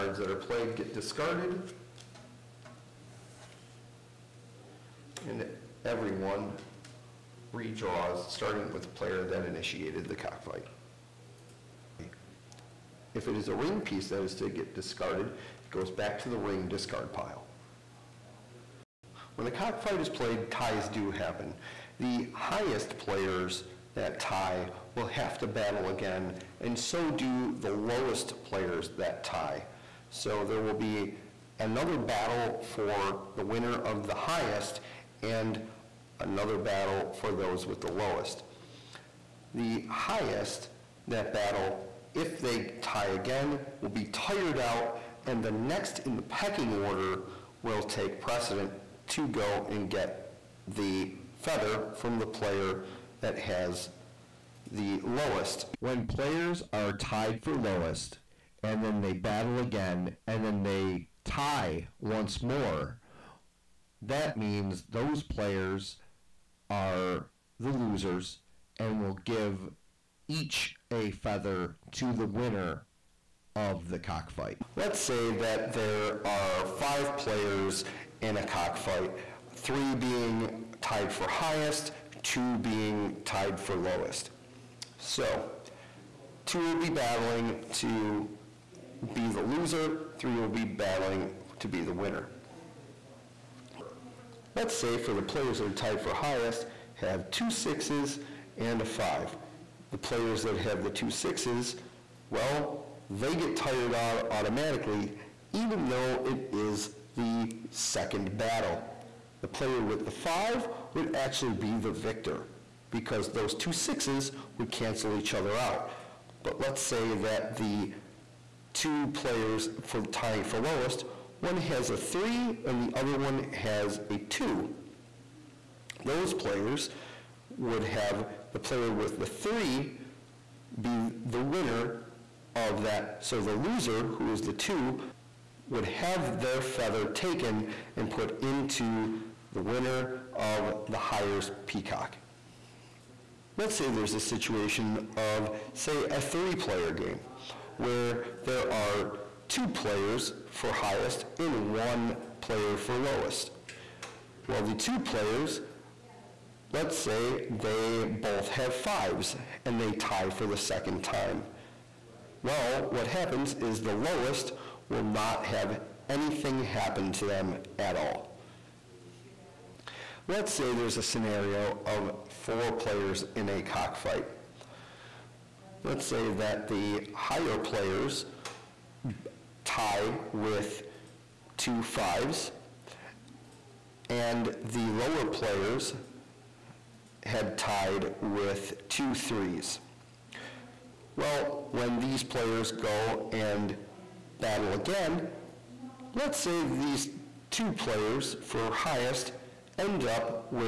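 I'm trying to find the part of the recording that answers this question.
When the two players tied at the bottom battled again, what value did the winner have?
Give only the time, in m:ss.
2:08.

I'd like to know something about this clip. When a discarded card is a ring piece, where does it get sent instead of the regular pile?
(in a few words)
Ring discard pile.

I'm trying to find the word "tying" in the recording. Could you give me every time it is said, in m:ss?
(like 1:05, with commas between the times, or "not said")
2:00.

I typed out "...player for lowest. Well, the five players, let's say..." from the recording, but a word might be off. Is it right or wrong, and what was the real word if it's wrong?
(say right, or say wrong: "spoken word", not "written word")
wrong: "two", not "five".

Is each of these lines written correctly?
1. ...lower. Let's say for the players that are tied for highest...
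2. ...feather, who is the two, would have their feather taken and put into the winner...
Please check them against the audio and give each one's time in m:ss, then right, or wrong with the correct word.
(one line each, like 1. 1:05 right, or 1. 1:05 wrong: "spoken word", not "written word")
1. 1:31 wrong: "winner", not "lower"
2. 2:13 wrong: "loser", not "feather".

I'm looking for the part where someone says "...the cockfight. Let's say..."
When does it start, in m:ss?
1:13.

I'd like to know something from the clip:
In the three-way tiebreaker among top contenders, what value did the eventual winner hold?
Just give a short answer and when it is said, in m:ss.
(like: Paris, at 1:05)
5, at 1:49.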